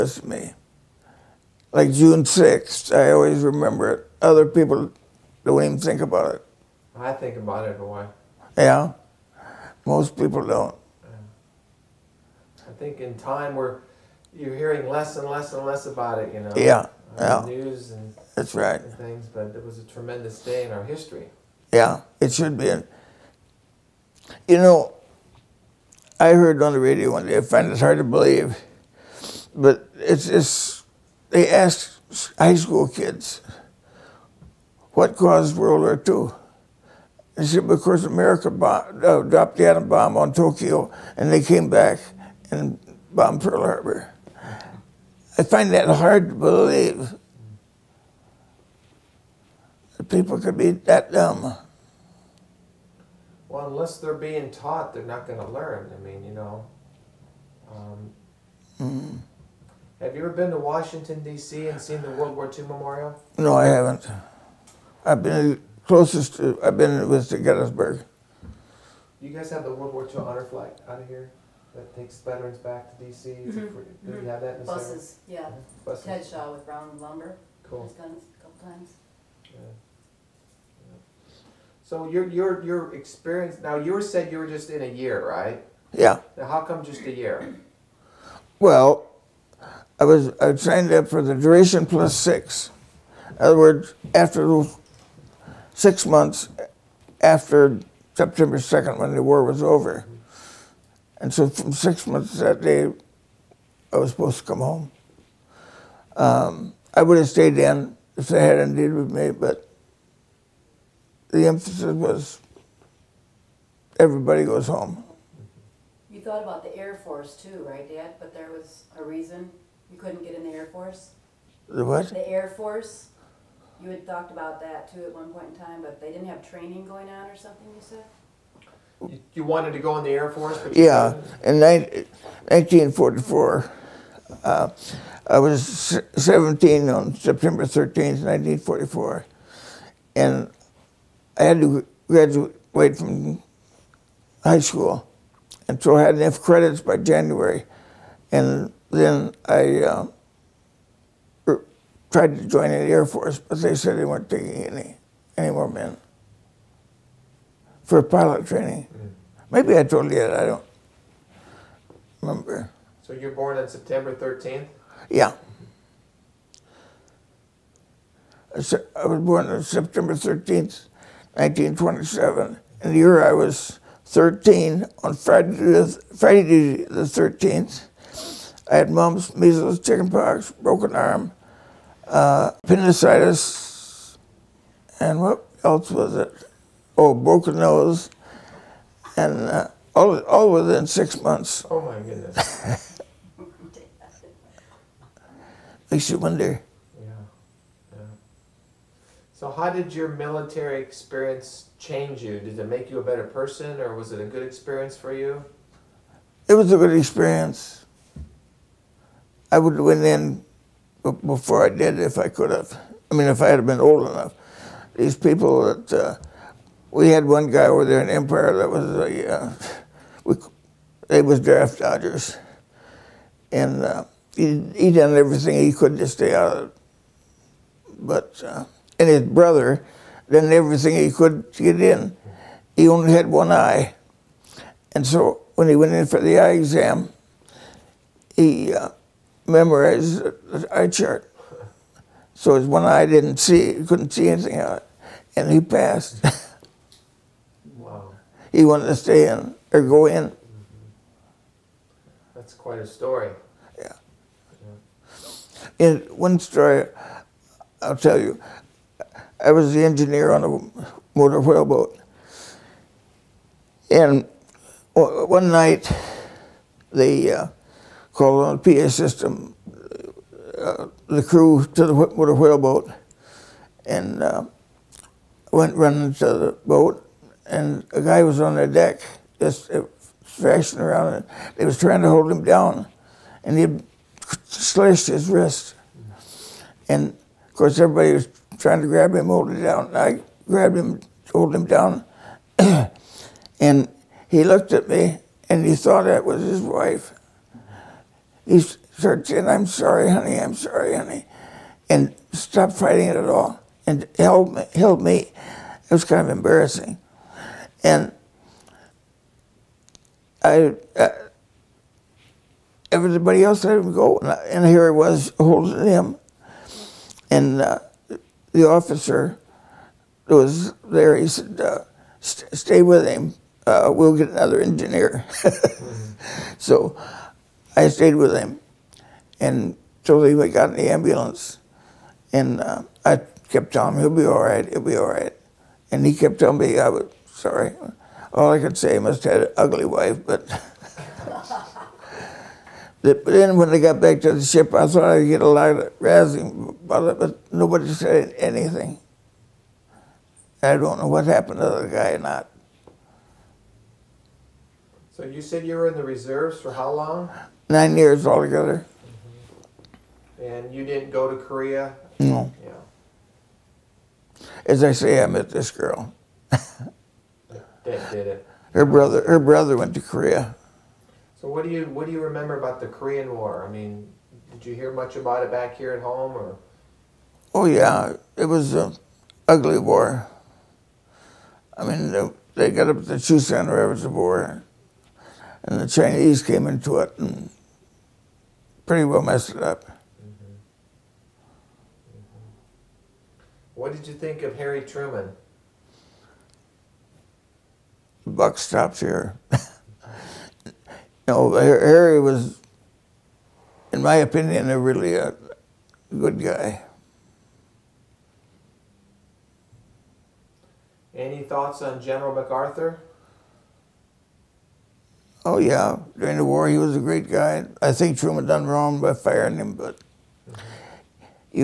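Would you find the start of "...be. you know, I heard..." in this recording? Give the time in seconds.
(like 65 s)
22 s.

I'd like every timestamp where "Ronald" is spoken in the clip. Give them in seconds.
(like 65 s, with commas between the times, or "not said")
not said.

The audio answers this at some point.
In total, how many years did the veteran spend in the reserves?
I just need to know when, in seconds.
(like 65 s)
357 s.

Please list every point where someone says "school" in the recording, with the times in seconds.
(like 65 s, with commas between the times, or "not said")
32 s, 144 s.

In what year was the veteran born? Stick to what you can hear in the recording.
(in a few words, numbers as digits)
1927.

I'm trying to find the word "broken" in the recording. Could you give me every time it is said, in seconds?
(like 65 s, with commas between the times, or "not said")
180 s, 187 s.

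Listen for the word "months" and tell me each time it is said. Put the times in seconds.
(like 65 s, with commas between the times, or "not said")
96 s, 102 s, 191 s.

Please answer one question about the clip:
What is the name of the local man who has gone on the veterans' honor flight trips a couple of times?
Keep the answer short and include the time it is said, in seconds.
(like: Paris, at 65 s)
Ted Shaw, at 76 s.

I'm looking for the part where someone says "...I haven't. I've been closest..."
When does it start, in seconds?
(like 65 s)
63 s.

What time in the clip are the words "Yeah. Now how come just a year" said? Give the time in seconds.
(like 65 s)
85 s.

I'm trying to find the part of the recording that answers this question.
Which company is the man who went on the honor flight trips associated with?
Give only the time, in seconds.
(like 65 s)
76 s.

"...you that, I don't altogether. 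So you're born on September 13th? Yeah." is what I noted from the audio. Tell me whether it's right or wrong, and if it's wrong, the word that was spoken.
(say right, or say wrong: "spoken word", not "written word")
wrong: "remember", not "altogether".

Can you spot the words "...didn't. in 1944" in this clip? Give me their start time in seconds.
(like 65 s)
131 s.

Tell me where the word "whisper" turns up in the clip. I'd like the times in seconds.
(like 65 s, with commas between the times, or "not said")
not said.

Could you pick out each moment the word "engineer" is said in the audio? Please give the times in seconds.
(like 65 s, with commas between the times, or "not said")
259 s, 324 s.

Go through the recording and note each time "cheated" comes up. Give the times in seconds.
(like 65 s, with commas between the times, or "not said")
not said.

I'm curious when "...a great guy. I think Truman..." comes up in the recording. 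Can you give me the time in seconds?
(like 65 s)
416 s.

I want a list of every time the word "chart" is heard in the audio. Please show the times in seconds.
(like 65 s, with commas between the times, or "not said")
240 s.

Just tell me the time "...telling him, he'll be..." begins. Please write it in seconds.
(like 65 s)
333 s.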